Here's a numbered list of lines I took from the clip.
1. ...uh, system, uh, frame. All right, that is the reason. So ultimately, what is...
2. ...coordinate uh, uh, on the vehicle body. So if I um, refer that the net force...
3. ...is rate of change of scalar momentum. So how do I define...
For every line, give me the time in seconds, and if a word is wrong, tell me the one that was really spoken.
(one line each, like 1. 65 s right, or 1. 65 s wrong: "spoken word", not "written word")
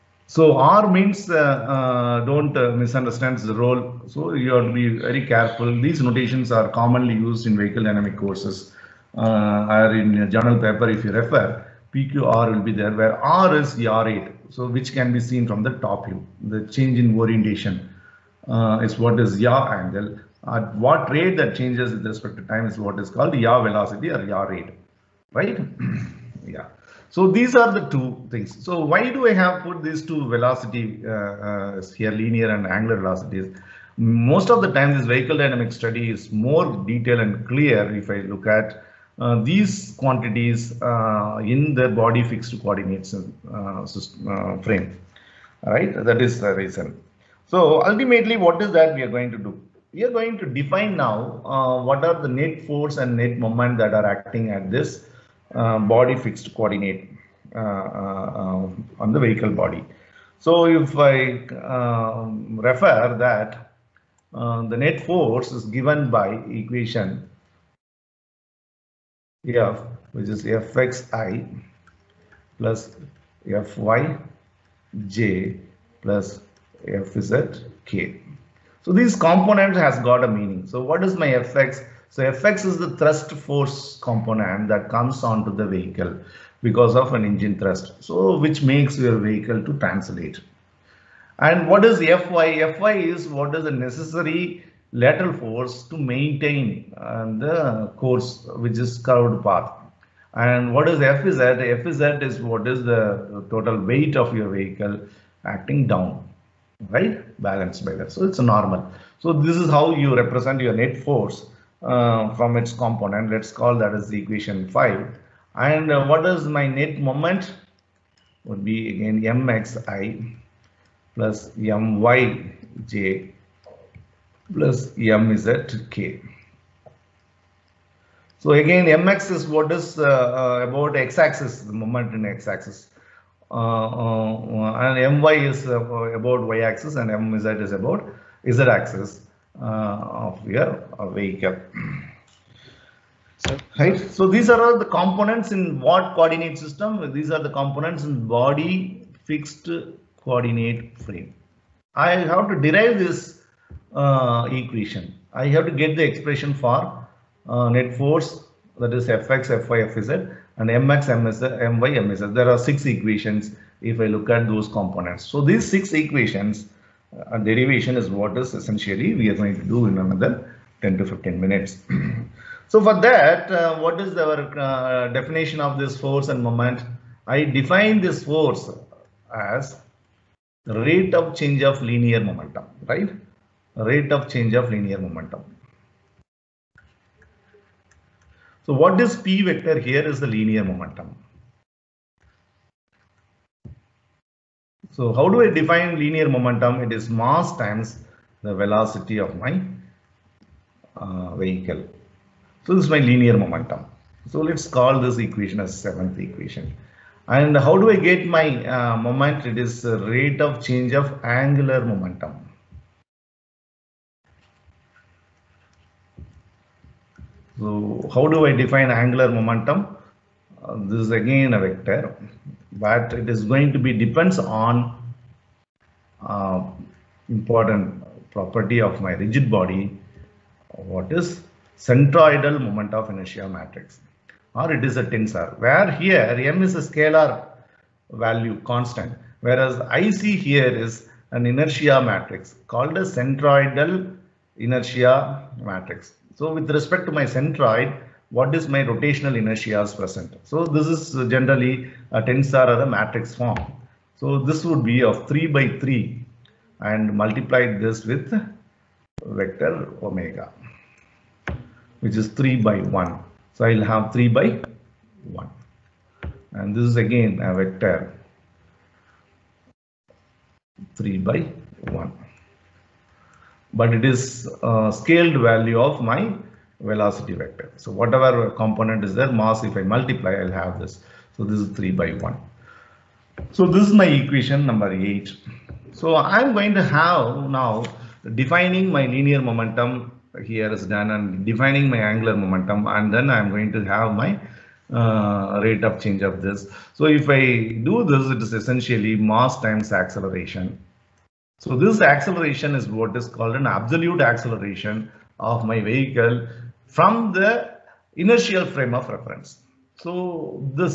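1. 43 s right
2. 56 s right
3. 209 s wrong: "angular", not "scalar".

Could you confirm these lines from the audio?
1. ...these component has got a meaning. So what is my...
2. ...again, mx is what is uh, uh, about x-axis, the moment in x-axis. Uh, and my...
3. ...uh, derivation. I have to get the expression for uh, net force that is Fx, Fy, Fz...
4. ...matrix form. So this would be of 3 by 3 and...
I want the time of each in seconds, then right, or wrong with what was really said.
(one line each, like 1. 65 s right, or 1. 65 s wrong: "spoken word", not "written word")
1. 78 s right
2. 128 s right
3. 153 s wrong: "equation", not "derivation"
4. 252 s right.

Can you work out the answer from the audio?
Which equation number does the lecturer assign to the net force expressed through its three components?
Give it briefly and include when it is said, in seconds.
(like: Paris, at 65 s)
5, at 114 s.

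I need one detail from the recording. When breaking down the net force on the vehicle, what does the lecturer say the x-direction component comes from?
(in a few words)
engine thrust.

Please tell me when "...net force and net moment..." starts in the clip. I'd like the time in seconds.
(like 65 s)
52 s.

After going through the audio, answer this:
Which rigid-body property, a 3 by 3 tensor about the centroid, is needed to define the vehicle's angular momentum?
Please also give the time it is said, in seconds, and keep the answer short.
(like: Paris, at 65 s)
centroidal moment of inertia, at 231 s.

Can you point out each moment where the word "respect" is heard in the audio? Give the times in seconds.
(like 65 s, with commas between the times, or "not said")
22 s, 246 s.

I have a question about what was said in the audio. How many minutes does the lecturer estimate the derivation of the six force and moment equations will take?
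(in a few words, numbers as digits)
10 to 15.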